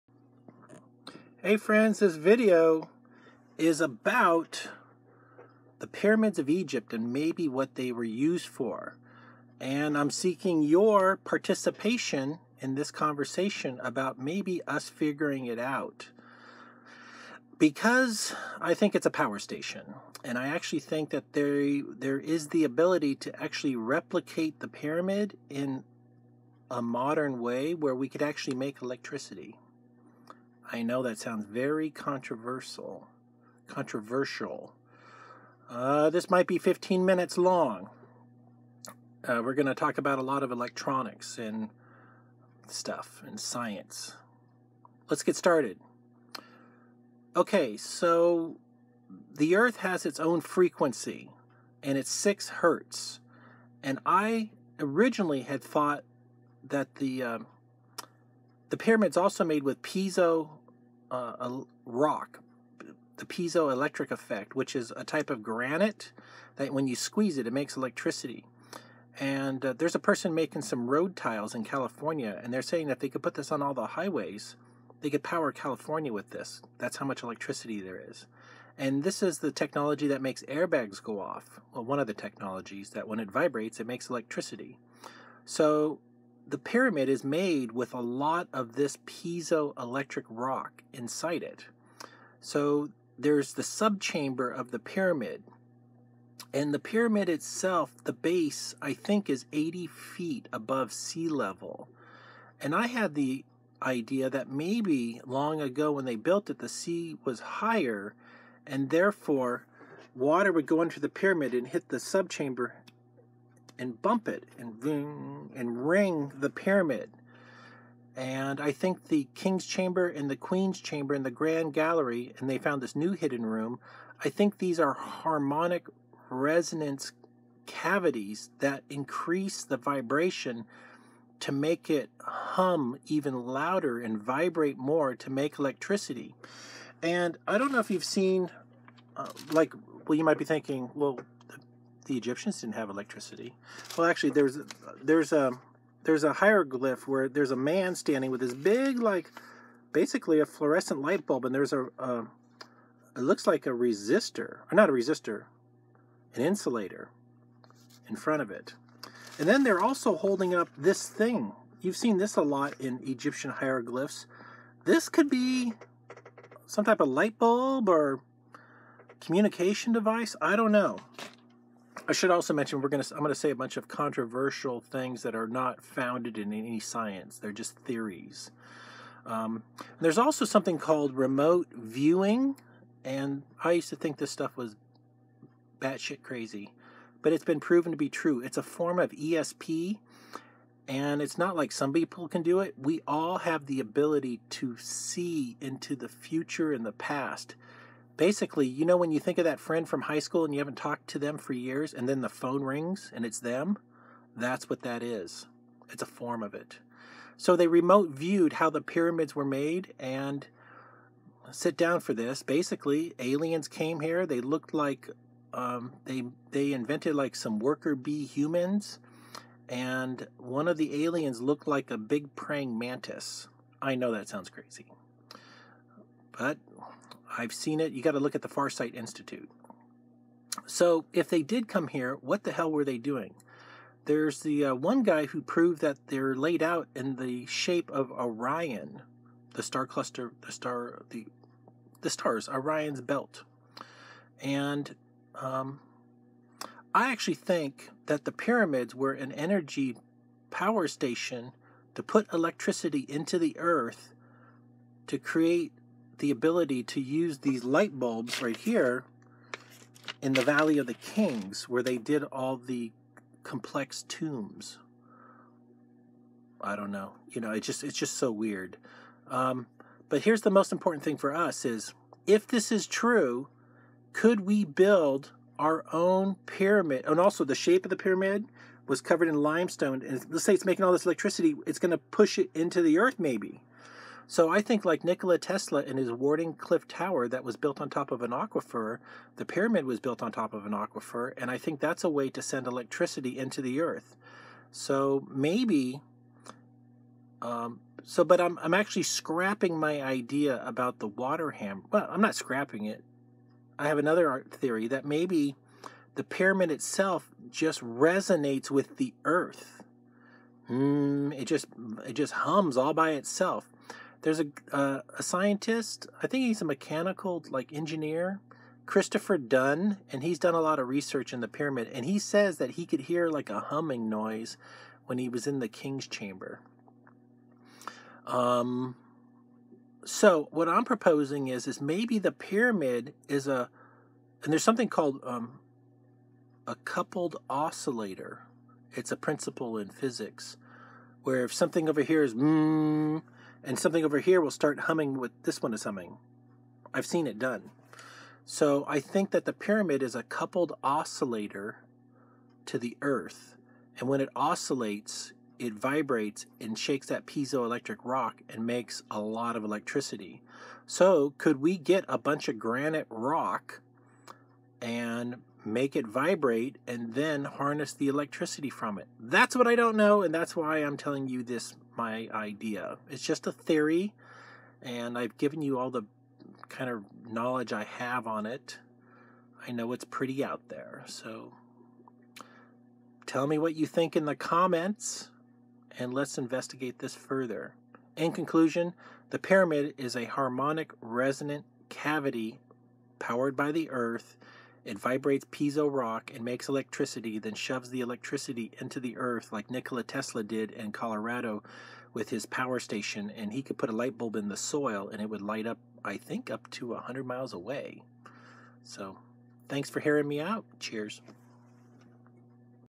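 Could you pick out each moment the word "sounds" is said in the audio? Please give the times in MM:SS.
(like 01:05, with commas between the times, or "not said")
00:31, 03:44.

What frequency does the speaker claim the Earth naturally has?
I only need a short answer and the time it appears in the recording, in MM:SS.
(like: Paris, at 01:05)
6 hertz, at 00:52.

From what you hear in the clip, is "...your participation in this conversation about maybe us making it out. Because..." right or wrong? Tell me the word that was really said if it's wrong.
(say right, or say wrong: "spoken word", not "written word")
wrong: "figuring", not "making".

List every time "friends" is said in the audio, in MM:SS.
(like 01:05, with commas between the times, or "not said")
00:01, 03:19.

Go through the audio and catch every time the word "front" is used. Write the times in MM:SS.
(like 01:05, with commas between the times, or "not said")
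02:38.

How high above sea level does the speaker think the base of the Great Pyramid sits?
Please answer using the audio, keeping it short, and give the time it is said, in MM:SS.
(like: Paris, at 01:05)
80 feet, at 01:39.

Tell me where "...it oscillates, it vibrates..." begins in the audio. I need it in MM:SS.
05:54.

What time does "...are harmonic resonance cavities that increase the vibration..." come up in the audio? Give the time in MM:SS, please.
02:04.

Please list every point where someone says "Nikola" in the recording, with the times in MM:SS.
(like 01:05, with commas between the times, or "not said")
04:45, 06:39.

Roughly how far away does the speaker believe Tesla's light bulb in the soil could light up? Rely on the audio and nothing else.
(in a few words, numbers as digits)
100 miles.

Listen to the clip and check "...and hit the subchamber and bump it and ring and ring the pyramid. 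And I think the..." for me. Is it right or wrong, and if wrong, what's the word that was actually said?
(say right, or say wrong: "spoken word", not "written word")
right.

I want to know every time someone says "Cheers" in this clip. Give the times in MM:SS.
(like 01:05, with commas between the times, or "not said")
06:50.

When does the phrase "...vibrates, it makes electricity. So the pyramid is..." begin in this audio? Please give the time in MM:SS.
01:23.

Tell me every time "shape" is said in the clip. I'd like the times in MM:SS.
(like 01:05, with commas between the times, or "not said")
03:57, 04:37.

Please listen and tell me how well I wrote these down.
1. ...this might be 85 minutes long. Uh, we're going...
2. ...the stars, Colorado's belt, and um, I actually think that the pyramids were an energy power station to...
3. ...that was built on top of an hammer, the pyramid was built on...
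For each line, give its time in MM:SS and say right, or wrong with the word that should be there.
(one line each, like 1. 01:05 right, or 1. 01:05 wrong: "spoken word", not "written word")
1. 00:36 wrong: "15", not "85"
2. 04:02 wrong: "Orion", not "Colorado"
3. 04:47 wrong: "aquifer", not "hammer".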